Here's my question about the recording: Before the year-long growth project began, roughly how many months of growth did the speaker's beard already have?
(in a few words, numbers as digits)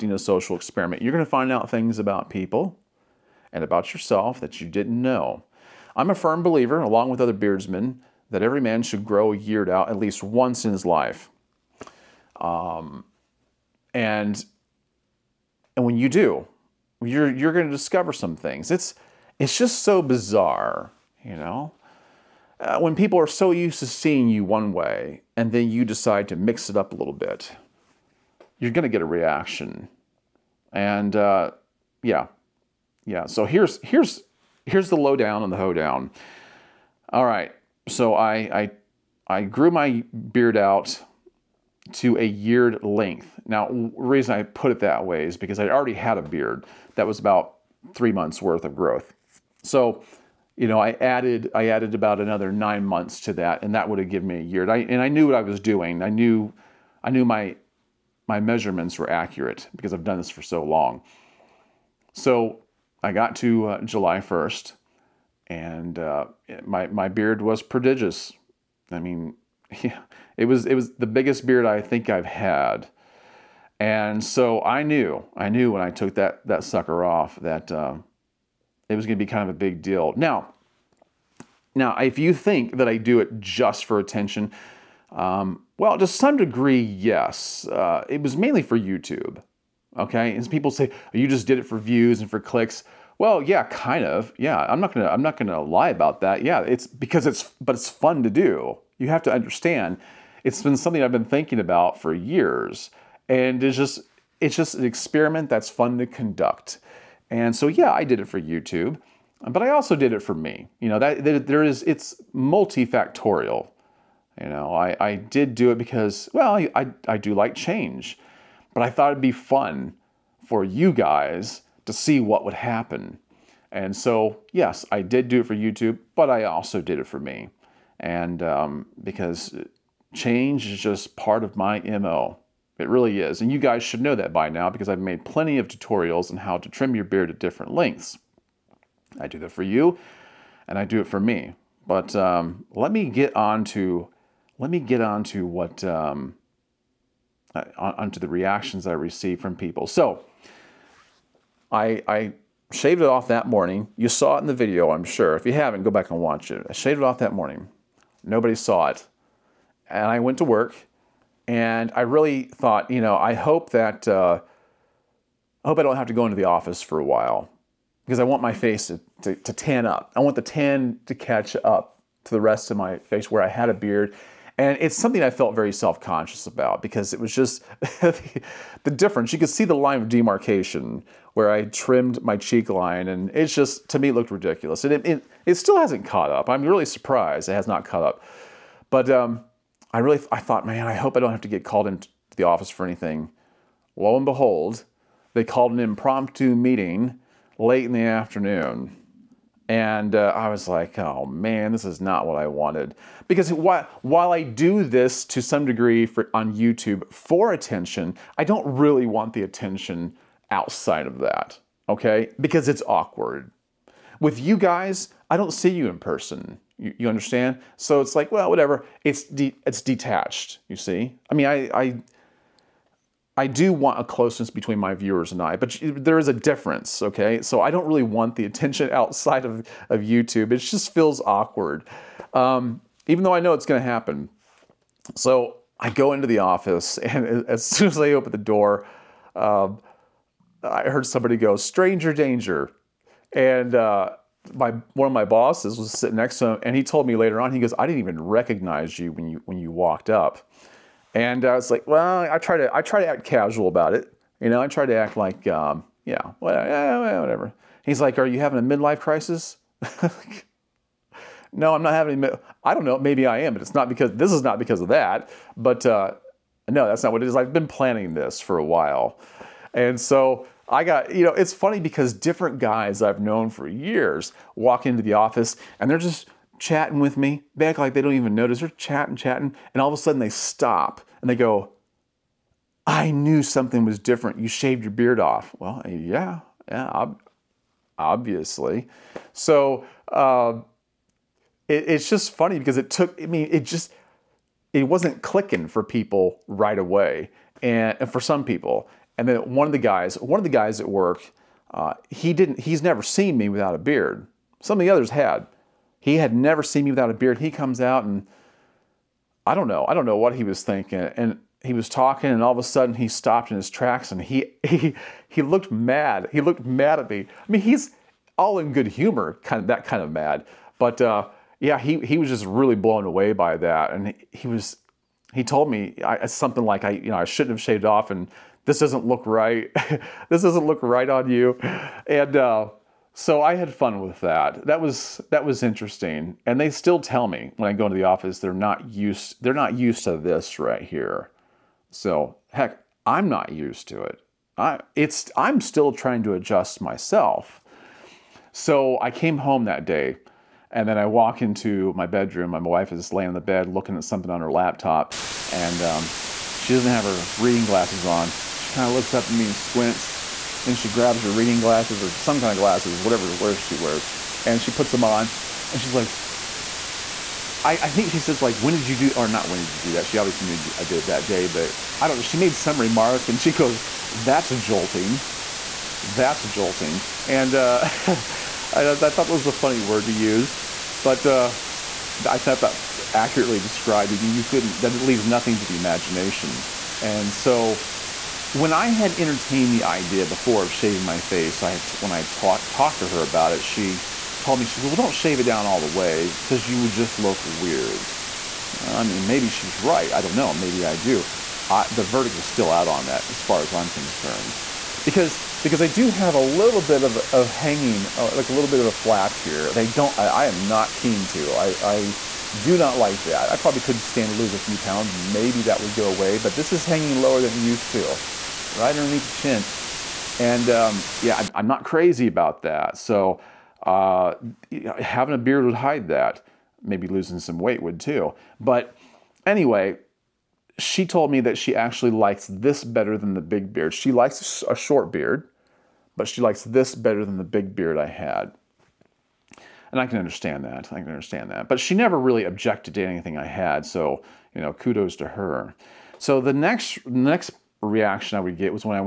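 3 months.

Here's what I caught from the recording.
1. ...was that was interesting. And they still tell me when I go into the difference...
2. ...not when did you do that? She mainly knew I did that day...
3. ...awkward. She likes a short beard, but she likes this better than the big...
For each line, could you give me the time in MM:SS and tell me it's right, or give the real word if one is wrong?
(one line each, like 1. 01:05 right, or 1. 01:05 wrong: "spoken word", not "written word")
1. 05:34 wrong: "office", not "difference"
2. 06:09 wrong: "obviously", not "mainly"
3. 07:13 wrong: "beard", not "awkward".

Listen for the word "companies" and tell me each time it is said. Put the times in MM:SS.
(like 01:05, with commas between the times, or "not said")
not said.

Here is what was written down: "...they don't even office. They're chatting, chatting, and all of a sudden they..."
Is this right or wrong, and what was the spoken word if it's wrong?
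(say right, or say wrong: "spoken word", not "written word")
wrong: "notice", not "office".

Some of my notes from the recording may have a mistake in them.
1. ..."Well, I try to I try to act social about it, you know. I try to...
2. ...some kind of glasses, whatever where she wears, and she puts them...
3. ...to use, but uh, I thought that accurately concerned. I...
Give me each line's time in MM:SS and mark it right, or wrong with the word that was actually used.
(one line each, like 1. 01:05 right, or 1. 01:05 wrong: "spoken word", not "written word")
1. 04:11 wrong: "casual", not "social"
2. 06:02 right
3. 06:20 wrong: "described", not "concerned".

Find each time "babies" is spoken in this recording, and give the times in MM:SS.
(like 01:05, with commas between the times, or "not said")
not said.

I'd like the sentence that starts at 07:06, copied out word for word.
Maybe losing some weight would too.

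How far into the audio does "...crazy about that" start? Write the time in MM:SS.
07:01.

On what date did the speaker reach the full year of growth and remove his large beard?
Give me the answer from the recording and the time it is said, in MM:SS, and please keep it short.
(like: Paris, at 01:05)
July 1, at 01:03.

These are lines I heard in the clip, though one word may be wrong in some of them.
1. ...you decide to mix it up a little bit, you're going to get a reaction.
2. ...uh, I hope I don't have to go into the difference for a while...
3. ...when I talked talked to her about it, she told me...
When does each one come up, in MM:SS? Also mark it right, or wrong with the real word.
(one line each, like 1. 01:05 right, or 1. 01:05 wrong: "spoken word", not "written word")
1. 00:25 right
2. 02:44 wrong: "office", not "difference"
3. 06:31 right.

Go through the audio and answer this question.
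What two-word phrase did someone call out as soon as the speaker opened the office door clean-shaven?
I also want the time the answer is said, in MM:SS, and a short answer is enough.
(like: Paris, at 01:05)
Stranger Danger, at 04:01.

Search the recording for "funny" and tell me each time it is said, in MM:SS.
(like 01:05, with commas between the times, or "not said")
04:31, 04:52, 06:19.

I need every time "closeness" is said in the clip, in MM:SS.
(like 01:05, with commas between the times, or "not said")
03:44.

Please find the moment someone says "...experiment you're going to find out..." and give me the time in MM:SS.
00:00.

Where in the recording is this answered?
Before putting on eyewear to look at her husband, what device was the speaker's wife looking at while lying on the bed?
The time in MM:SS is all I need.
05:54.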